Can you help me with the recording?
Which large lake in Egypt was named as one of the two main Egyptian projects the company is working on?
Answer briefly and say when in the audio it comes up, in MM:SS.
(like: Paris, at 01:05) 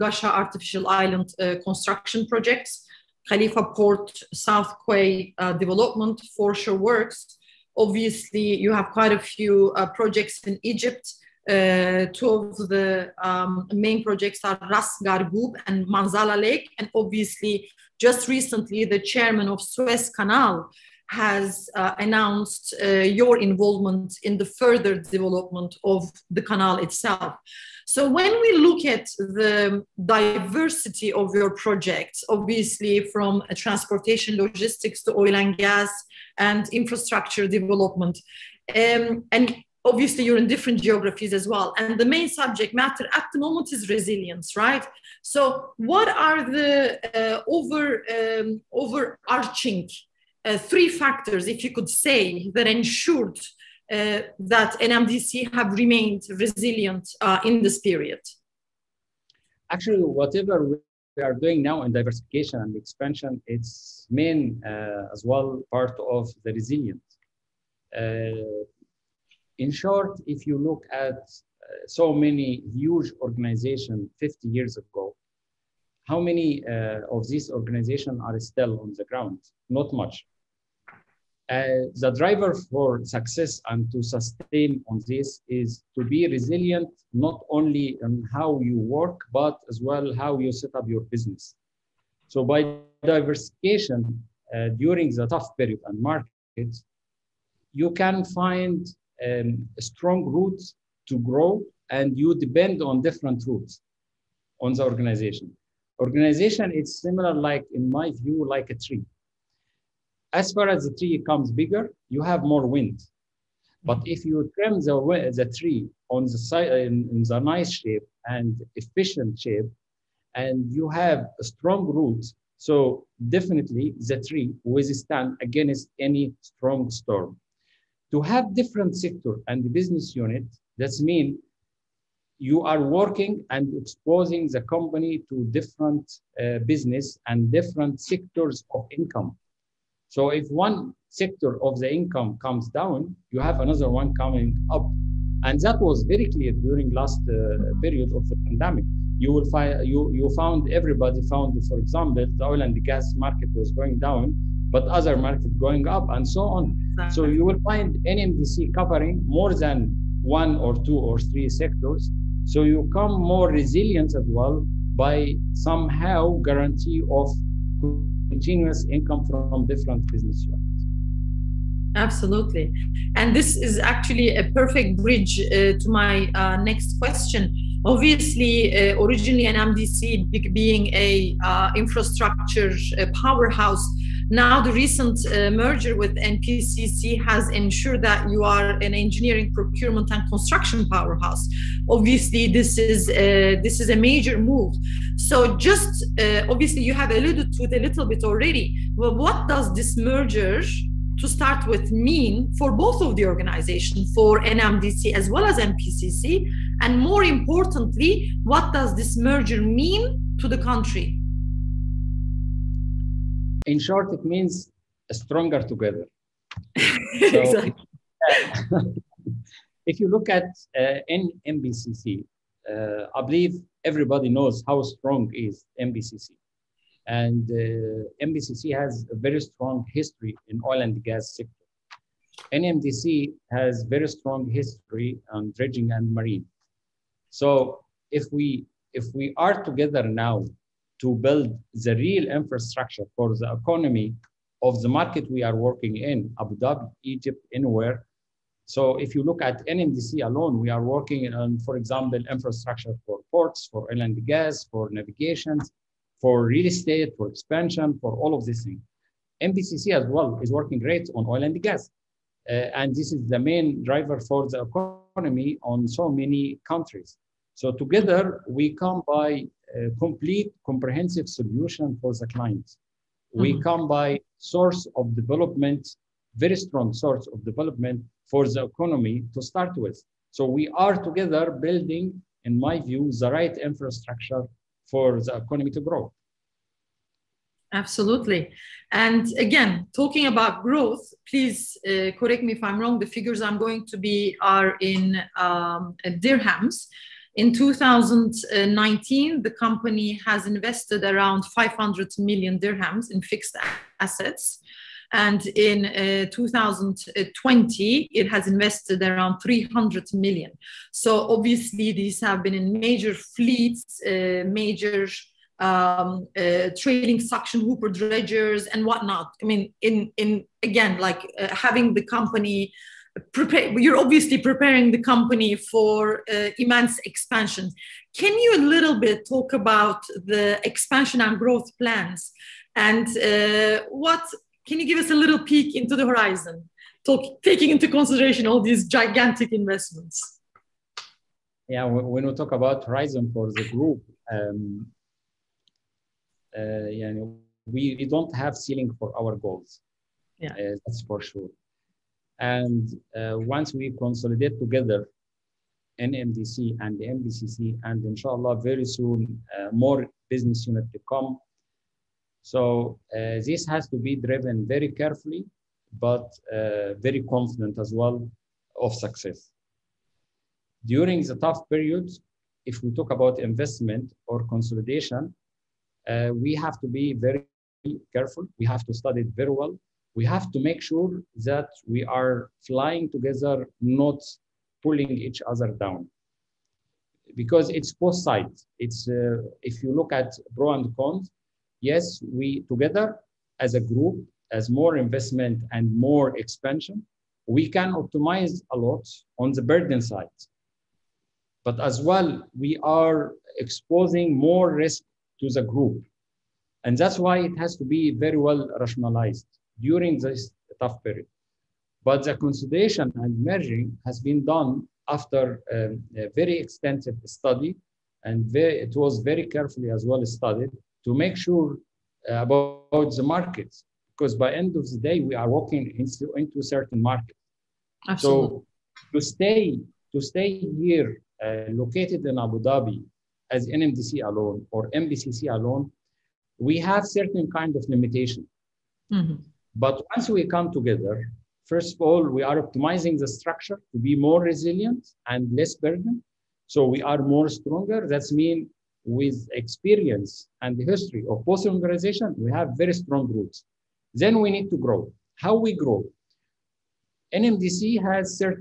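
Manzala Lake, at 00:15.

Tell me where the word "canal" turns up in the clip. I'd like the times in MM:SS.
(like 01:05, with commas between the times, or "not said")
00:20, 00:26.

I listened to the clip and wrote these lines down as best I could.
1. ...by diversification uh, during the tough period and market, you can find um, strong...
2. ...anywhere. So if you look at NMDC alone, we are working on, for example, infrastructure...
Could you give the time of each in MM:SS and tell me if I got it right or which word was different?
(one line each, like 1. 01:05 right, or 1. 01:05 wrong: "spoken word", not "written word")
1. 01:32 right
2. 04:07 right.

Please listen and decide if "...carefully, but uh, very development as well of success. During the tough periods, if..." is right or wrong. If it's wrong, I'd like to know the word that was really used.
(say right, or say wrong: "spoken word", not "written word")
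wrong: "confident", not "development".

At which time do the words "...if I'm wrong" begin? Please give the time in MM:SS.
04:52.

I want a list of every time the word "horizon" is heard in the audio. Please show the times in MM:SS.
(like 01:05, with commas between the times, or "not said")
05:36, 05:42.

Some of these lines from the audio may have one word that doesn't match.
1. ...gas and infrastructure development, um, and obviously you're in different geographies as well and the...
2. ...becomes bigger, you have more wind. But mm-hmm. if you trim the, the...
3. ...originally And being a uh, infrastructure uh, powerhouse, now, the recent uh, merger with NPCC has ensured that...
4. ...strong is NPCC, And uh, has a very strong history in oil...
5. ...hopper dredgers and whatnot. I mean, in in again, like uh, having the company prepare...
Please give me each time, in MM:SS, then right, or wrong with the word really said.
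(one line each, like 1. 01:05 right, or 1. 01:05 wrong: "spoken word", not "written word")
1. 00:35 right
2. 01:51 right
3. 02:59 wrong: "MDC", not "And"
4. 03:44 right
5. 05:17 right.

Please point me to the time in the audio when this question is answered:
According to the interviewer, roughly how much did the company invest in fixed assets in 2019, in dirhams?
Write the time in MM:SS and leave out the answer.
05:01.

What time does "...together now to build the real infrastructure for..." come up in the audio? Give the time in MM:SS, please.
03:59.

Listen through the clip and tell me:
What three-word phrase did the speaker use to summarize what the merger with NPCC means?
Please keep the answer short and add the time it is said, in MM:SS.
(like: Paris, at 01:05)
Stronger together, at 03:35.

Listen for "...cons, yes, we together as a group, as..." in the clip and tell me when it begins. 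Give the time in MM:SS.
06:30.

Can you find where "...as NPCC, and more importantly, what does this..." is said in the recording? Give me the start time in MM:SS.
03:25.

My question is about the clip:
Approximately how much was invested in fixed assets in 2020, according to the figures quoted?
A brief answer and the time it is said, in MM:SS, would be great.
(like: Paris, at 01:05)
300 million, at 05:09.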